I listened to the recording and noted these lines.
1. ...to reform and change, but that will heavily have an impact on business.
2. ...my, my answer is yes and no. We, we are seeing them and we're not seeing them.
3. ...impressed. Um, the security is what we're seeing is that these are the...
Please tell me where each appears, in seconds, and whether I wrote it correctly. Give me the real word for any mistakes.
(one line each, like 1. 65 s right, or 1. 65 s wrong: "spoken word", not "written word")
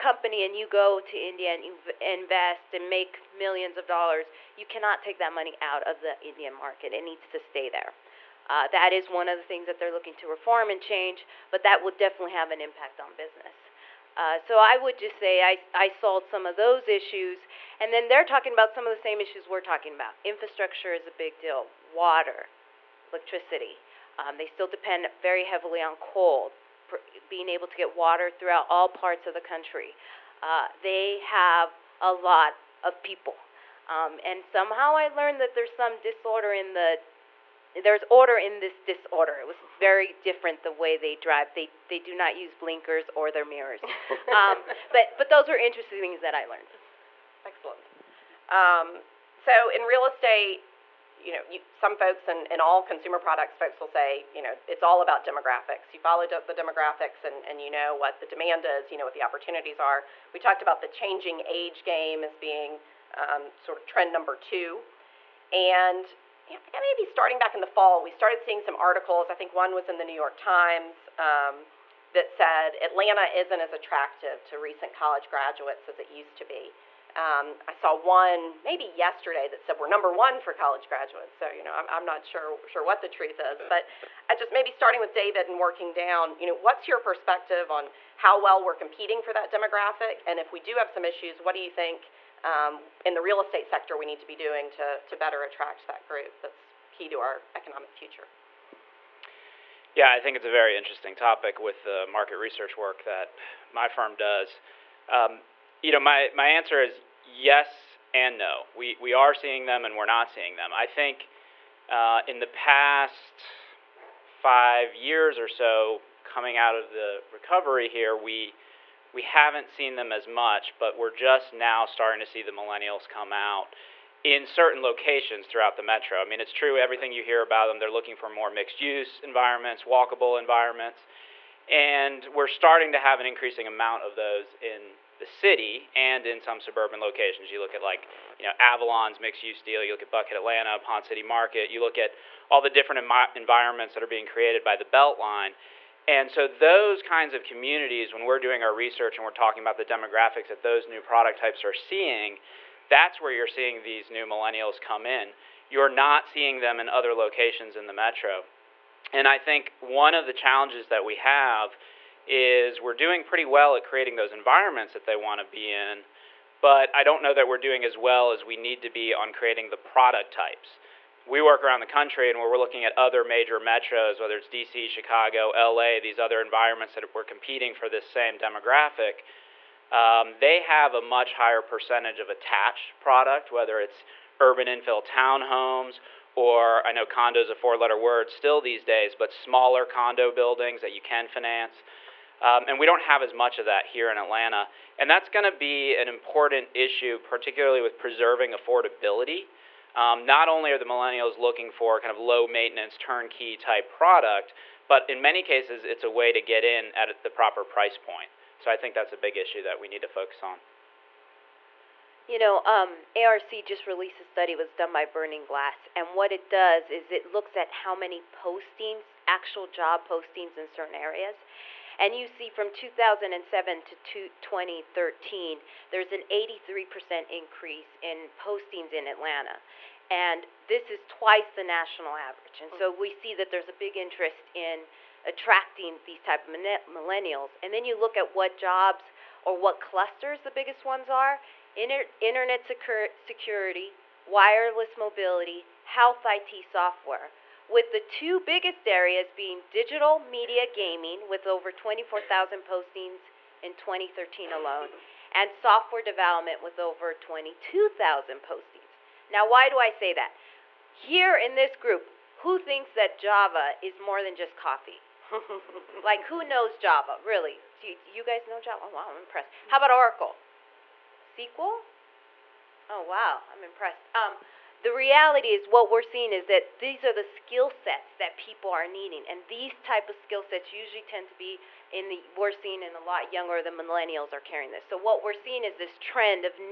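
1. 10 s wrong: "definitely", not "heavily"
2. 105 s right
3. 273 s wrong: "reality", not "security".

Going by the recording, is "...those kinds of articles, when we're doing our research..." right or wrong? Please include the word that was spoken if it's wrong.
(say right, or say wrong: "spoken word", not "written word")
wrong: "communities", not "articles".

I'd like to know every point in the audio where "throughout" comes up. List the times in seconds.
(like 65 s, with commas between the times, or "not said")
28 s, 125 s.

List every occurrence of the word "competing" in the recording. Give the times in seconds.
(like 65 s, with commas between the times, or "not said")
88 s, 177 s.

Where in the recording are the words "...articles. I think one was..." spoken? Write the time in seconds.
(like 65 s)
68 s.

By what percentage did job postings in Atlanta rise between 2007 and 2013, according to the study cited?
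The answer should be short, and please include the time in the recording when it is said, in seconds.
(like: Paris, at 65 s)
83%, at 226 s.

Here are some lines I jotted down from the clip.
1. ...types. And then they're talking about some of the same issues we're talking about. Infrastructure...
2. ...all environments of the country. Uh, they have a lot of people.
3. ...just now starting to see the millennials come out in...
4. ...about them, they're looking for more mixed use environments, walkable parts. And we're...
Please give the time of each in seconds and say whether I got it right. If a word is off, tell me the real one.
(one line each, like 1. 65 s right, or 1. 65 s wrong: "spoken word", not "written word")
1. 16 s wrong: "issues", not "types"
2. 28 s wrong: "parts", not "environments"
3. 121 s right
4. 127 s wrong: "environments", not "parts".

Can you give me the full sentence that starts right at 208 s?
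So I think that's a big issue that we need to focus on.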